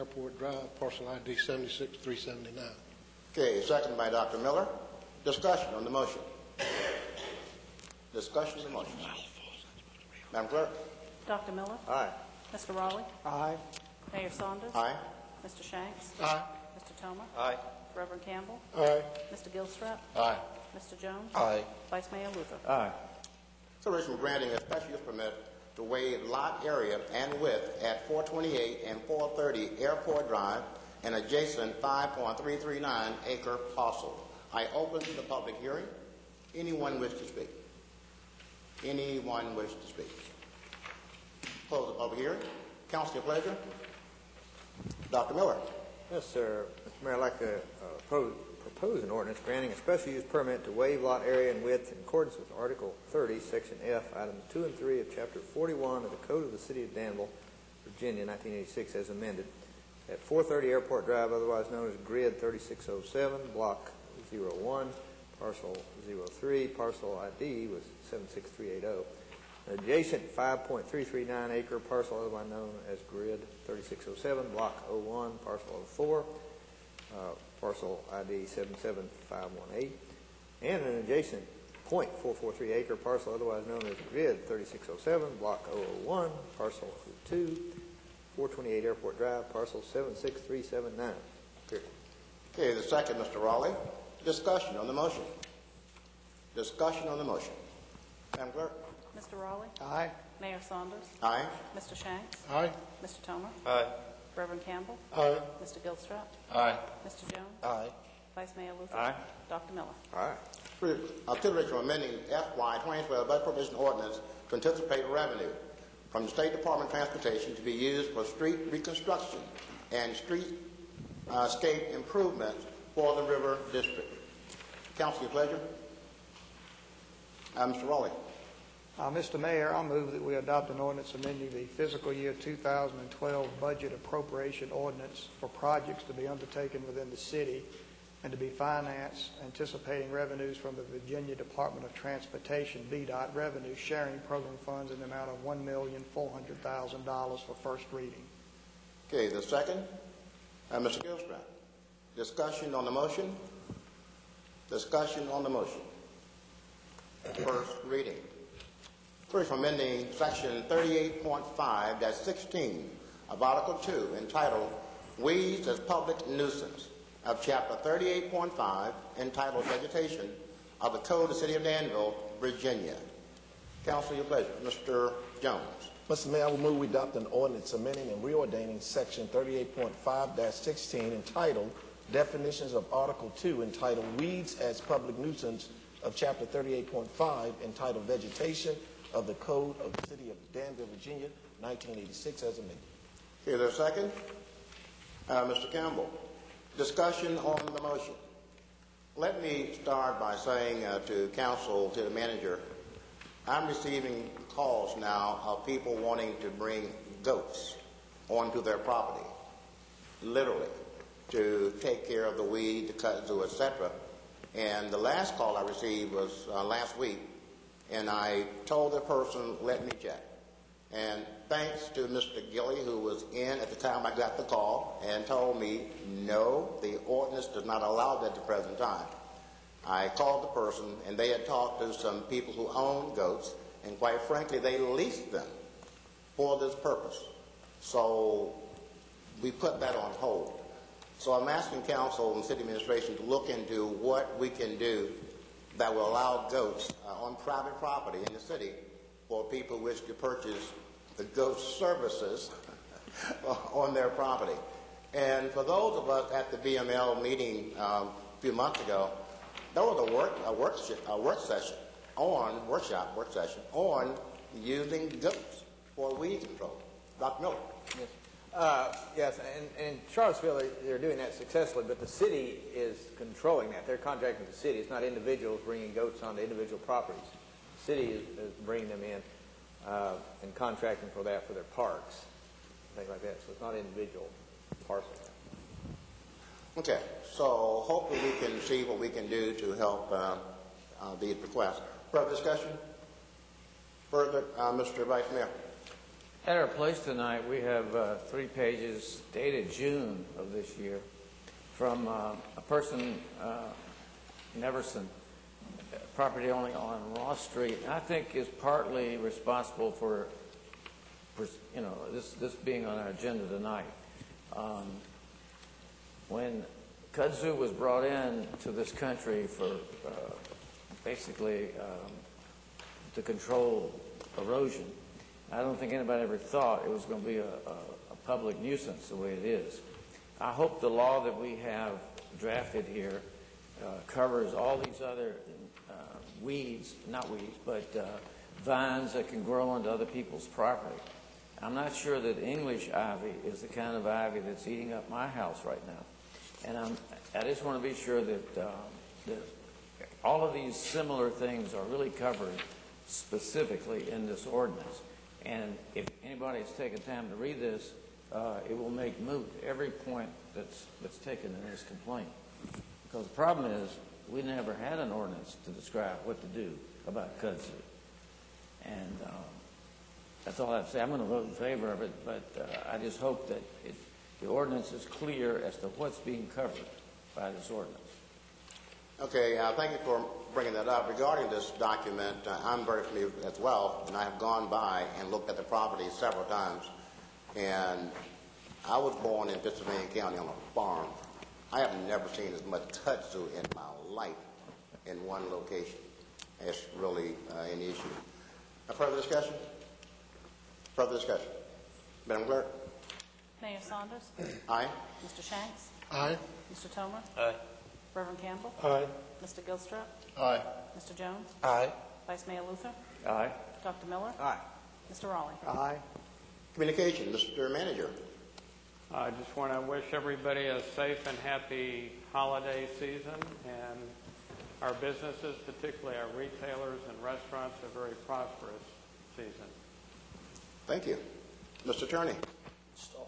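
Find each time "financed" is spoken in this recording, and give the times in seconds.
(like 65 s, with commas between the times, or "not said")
138 s.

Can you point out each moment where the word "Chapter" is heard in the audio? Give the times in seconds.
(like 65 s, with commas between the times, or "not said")
55 s, 167 s, 186 s.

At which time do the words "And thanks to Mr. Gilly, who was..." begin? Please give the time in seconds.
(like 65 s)
220 s.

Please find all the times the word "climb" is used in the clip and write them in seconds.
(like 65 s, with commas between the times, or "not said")
not said.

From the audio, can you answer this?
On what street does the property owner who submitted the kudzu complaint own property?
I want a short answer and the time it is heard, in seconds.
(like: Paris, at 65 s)
Ross Street, at 307 s.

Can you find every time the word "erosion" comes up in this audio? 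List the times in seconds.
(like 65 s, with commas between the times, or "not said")
324 s.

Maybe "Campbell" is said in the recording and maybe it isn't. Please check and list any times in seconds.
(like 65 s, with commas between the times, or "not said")
18 s, 104 s, 195 s, 408 s.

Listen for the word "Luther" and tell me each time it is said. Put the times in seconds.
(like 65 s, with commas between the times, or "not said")
22 s, 108 s, 412 s.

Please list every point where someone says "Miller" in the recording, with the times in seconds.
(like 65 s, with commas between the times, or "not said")
4 s, 11 s, 45 s, 109 s, 267 s, 414 s.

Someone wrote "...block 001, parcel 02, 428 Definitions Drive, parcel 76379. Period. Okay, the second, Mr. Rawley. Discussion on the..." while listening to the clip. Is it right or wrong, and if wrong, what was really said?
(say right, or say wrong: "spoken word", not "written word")
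wrong: "Airport", not "Definitions".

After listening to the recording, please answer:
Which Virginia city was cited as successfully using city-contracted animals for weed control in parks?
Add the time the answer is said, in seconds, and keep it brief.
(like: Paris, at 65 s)
Charlottesville, at 270 s.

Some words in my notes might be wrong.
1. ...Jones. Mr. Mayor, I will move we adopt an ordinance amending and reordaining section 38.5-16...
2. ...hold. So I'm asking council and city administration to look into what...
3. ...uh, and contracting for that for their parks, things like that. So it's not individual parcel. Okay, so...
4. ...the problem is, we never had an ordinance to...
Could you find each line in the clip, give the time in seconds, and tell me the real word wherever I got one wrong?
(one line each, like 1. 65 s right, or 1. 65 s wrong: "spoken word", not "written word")
1. 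175 s right
2. 240 s right
3. 279 s right
4. 363 s right.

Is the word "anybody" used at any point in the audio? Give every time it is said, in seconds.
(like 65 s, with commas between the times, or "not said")
325 s, 356 s.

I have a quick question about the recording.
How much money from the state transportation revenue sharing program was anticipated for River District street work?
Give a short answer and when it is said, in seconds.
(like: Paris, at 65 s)
$1,400,000, at 145 s.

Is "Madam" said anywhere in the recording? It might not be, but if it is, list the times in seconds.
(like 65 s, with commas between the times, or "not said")
10 s, 98 s, 402 s.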